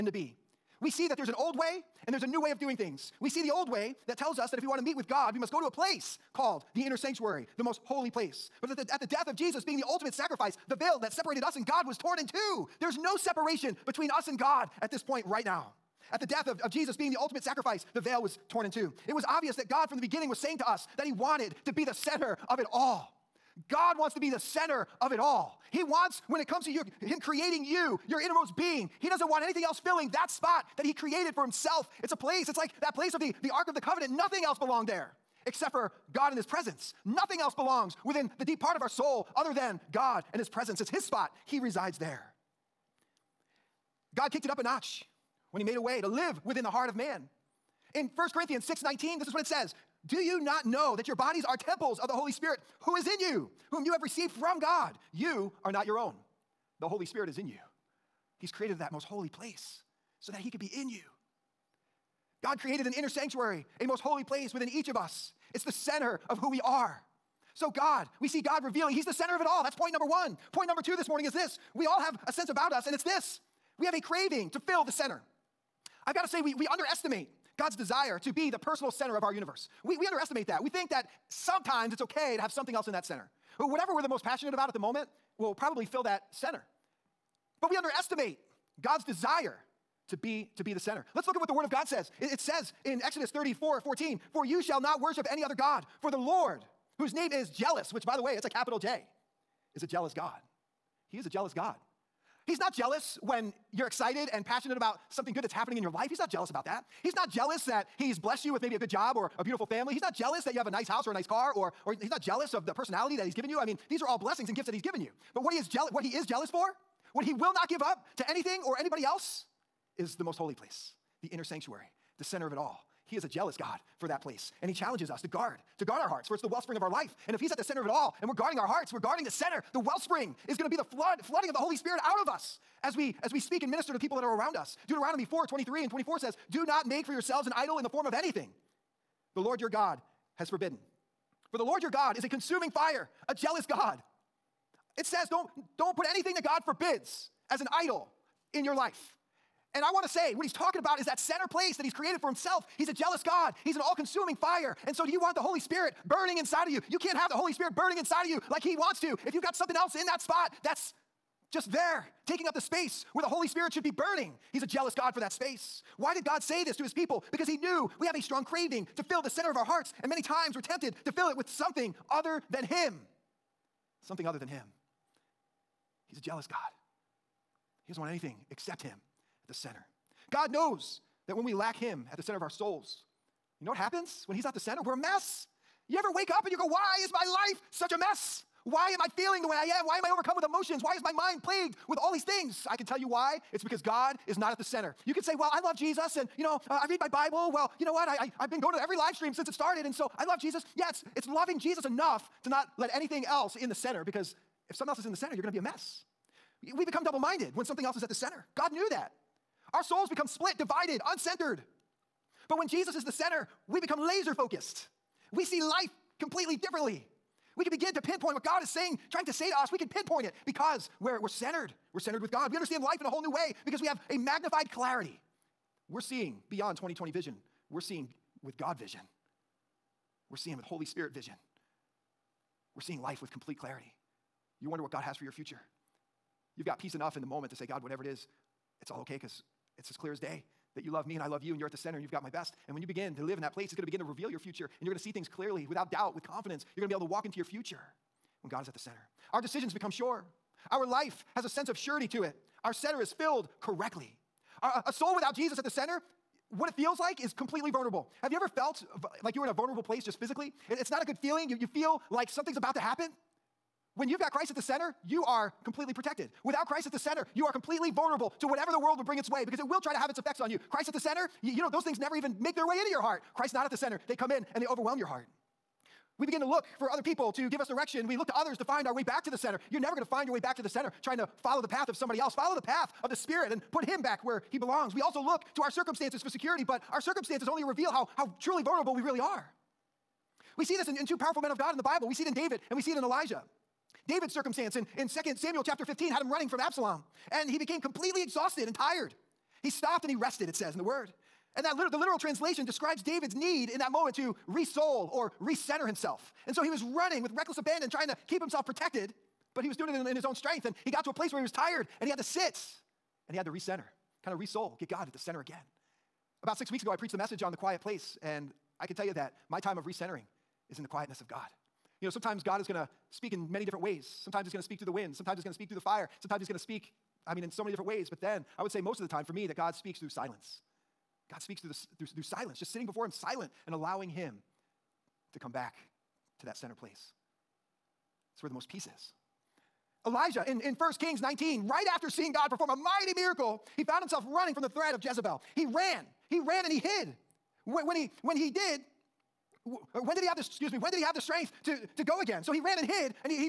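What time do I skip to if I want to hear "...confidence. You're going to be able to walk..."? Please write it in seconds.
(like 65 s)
246 s.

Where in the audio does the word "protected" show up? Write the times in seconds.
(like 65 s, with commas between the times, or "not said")
265 s, 308 s.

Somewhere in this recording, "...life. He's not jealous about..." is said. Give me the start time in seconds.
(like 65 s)
105 s.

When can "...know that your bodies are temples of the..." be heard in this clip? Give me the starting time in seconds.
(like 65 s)
50 s.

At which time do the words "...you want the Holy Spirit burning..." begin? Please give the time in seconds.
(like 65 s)
155 s.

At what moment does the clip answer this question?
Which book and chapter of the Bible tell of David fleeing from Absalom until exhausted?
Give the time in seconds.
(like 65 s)
295 s.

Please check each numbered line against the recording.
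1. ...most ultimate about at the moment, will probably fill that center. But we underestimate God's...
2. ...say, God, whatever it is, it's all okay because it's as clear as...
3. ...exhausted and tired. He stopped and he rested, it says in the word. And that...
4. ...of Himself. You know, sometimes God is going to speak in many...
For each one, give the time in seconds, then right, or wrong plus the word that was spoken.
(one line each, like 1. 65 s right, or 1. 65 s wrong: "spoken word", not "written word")
1. 84 s wrong: "passionate", not "ultimate"
2. 237 s right
3. 298 s right
4. 321 s wrong: "God", not "Himself".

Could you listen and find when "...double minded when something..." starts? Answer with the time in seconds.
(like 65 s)
207 s.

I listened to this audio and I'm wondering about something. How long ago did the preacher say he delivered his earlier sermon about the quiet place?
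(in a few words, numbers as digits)
6 weeks.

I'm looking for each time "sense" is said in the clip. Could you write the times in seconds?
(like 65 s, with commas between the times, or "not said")
72 s, 251 s.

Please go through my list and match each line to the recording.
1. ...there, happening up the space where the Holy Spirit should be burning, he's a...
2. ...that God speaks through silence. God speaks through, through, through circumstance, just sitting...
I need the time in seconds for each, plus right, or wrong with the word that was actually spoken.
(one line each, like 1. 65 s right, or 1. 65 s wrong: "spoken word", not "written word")
1. 161 s wrong: "taking", not "happening"
2. 329 s wrong: "silence", not "circumstance".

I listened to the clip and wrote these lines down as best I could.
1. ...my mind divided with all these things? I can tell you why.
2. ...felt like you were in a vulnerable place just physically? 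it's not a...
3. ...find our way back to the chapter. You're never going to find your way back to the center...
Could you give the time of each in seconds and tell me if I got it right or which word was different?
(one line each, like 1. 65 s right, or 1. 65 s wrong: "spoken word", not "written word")
1. 191 s wrong: "plagued", not "divided"
2. 258 s right
3. 278 s wrong: "center", not "chapter".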